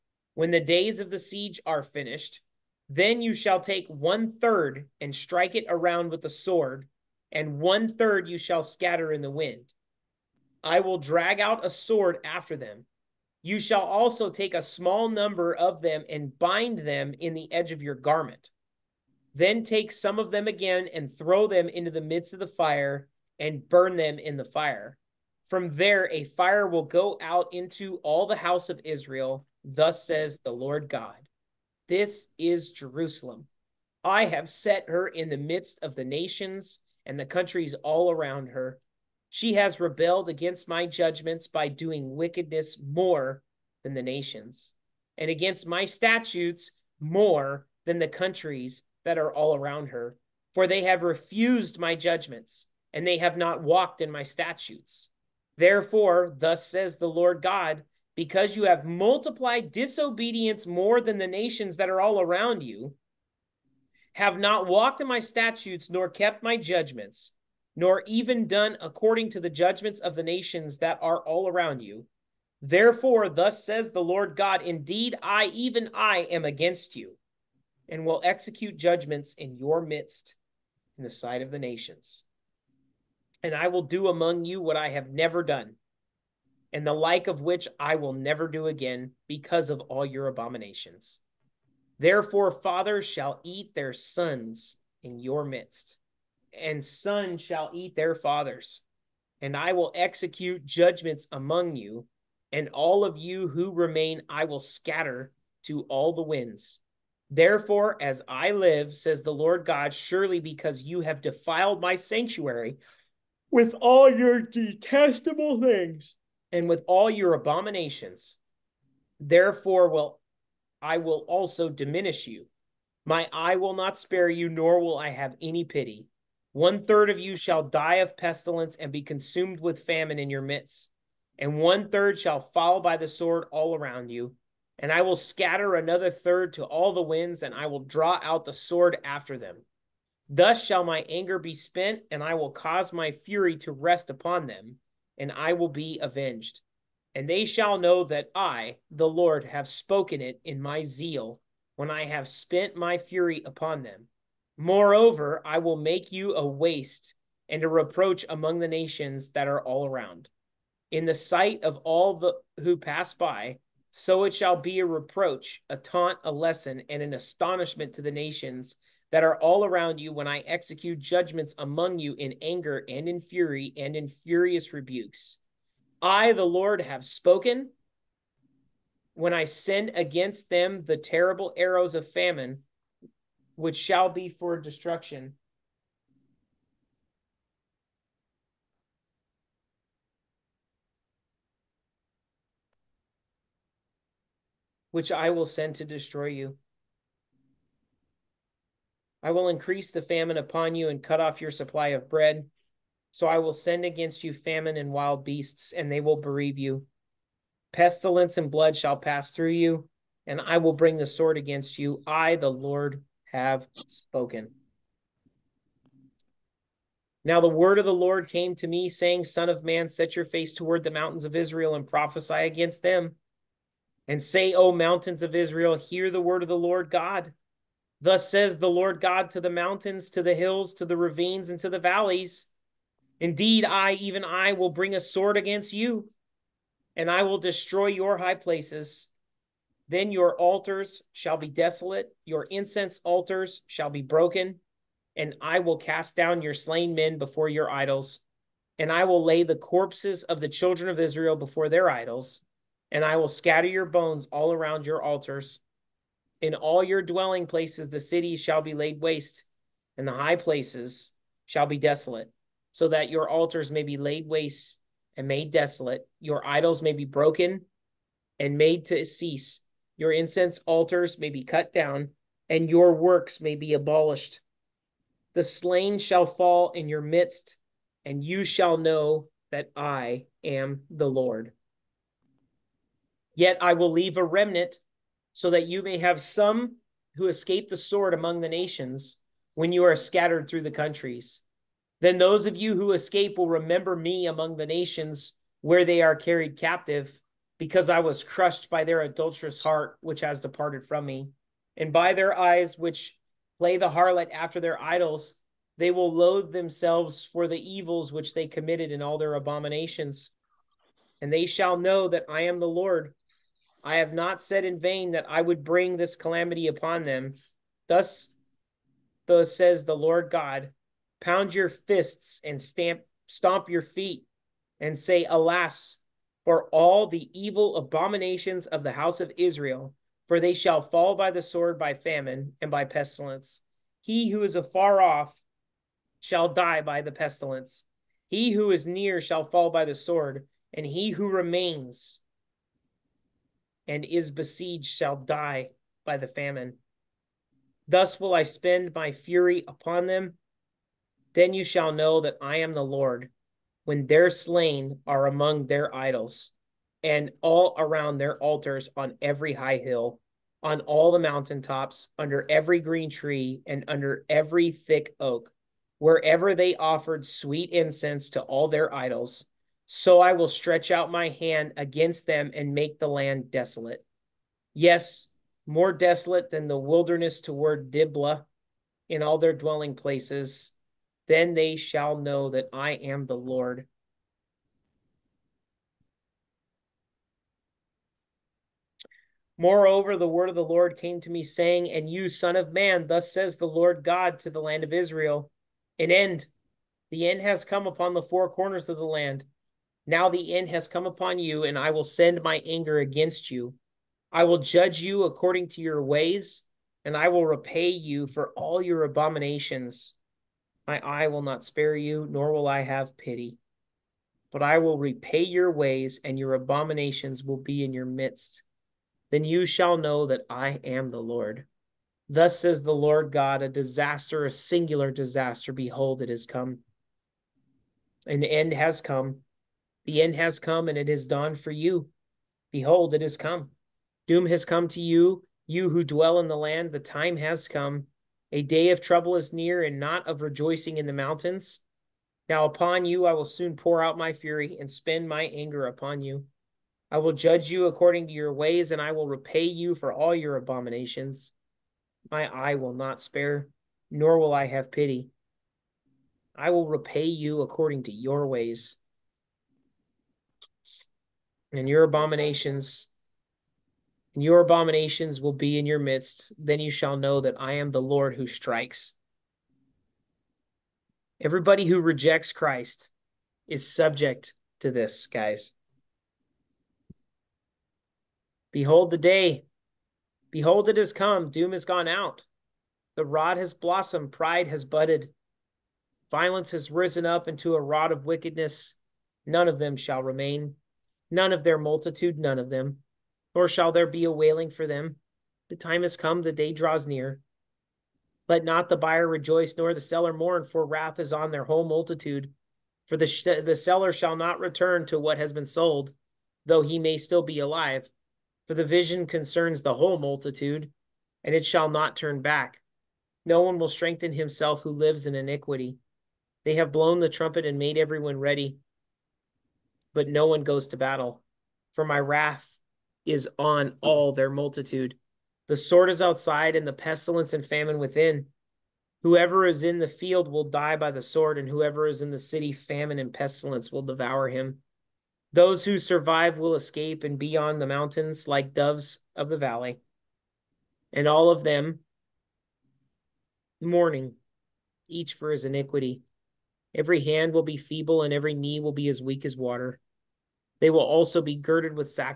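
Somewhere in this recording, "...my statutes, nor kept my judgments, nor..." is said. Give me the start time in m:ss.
1:05.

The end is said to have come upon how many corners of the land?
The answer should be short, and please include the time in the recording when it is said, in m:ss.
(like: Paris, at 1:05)
4, at 6:38.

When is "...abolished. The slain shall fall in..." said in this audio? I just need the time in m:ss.
4:33.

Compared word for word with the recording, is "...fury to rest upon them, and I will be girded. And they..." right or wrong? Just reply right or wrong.
wrong.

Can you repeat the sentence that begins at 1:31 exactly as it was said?
Therefore, fathers shall eat their sons in your midst, and sons shall eat their fathers.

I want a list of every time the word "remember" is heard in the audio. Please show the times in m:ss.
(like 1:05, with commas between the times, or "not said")
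4:53.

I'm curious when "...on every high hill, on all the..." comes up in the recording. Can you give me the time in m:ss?
5:58.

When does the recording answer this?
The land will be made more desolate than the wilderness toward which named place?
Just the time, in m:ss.
6:17.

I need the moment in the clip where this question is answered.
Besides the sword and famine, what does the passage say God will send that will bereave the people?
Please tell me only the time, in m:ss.
3:24.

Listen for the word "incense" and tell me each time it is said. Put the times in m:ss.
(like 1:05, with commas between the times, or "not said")
4:02, 4:30, 6:07.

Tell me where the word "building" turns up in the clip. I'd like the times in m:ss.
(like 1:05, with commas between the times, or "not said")
not said.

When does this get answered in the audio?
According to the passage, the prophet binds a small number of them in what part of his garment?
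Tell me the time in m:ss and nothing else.
0:17.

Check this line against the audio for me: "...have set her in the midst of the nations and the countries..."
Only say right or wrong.
right.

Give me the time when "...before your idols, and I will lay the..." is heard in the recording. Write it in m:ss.
4:07.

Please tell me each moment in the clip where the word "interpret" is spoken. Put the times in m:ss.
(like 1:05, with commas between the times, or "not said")
not said.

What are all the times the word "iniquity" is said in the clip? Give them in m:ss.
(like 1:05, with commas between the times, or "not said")
8:35, 9:05.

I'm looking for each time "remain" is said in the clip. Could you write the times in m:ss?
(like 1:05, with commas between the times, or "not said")
1:43, 5:41, 8:10.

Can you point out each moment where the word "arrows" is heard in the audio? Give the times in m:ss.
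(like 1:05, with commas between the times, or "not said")
3:01.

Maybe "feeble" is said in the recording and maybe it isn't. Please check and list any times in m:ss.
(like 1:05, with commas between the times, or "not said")
9:07.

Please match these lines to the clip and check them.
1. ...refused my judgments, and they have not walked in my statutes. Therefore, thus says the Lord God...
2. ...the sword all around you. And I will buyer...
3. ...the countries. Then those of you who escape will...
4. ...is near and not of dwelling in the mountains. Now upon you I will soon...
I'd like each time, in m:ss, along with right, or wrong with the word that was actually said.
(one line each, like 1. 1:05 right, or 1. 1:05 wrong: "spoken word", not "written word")
1. 0:51 right
2. 2:12 wrong: "scatter", not "buyer"
3. 4:50 right
4. 7:19 wrong: "rejoicing", not "dwelling".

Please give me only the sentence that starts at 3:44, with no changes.
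And say, O mountains of Israel, hear the word of the Lord God.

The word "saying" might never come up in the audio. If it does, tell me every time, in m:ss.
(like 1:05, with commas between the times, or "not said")
3:38, 6:31.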